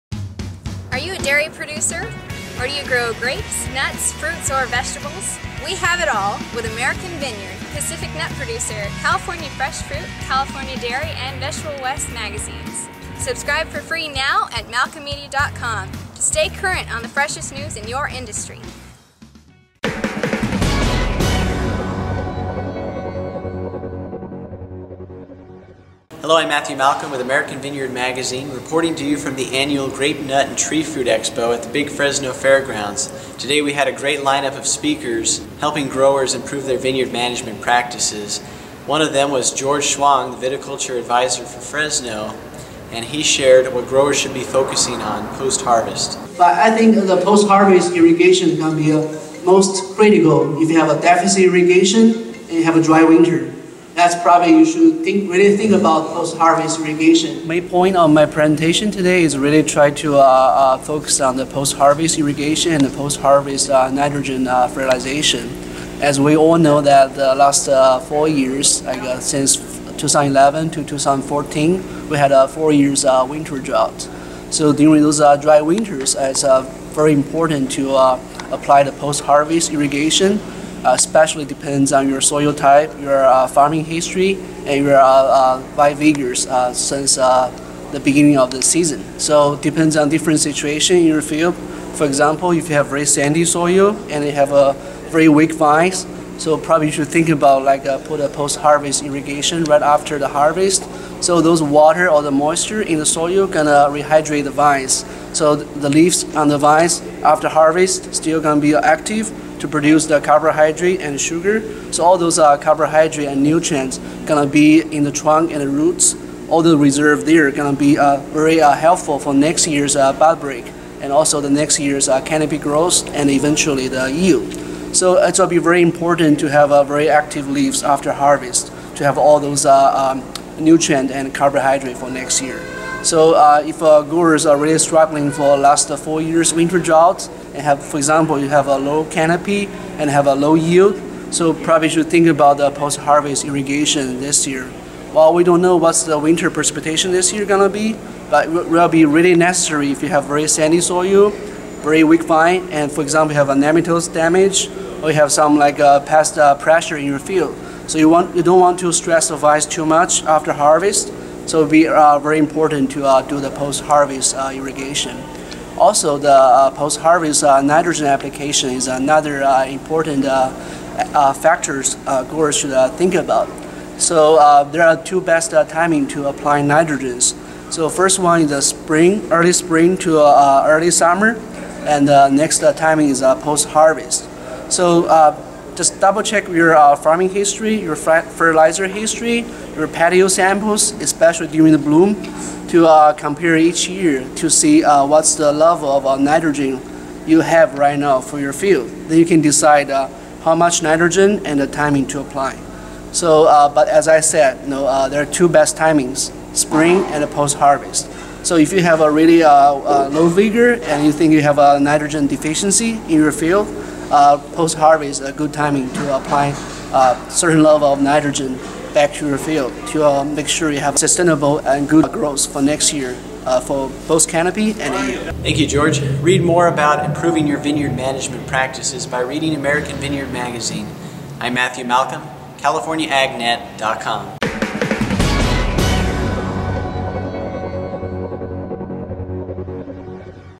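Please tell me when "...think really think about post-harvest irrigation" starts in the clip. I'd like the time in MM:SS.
00:55.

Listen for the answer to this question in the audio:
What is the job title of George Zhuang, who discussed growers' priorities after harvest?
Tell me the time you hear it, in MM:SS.
00:40.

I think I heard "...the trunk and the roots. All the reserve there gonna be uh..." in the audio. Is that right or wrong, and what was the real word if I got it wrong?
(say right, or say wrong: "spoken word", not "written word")
right.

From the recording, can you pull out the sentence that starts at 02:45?
Also, the uh, post-harvest uh, nitrogen application is another uh, important uh, factors growers should think about.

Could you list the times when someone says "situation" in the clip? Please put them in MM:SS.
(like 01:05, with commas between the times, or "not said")
01:30.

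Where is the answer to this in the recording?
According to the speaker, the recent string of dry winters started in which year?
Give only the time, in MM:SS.
01:10.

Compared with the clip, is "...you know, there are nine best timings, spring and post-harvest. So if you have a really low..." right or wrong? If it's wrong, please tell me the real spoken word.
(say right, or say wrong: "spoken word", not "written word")
wrong: "two", not "nine".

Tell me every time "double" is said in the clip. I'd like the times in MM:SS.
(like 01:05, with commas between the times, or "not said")
03:05.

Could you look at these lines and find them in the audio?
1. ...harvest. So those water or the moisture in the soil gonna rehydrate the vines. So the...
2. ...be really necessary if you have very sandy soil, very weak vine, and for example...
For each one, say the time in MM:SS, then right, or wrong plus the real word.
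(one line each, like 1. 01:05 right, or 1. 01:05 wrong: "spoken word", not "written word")
1. 01:40 right
2. 02:28 right.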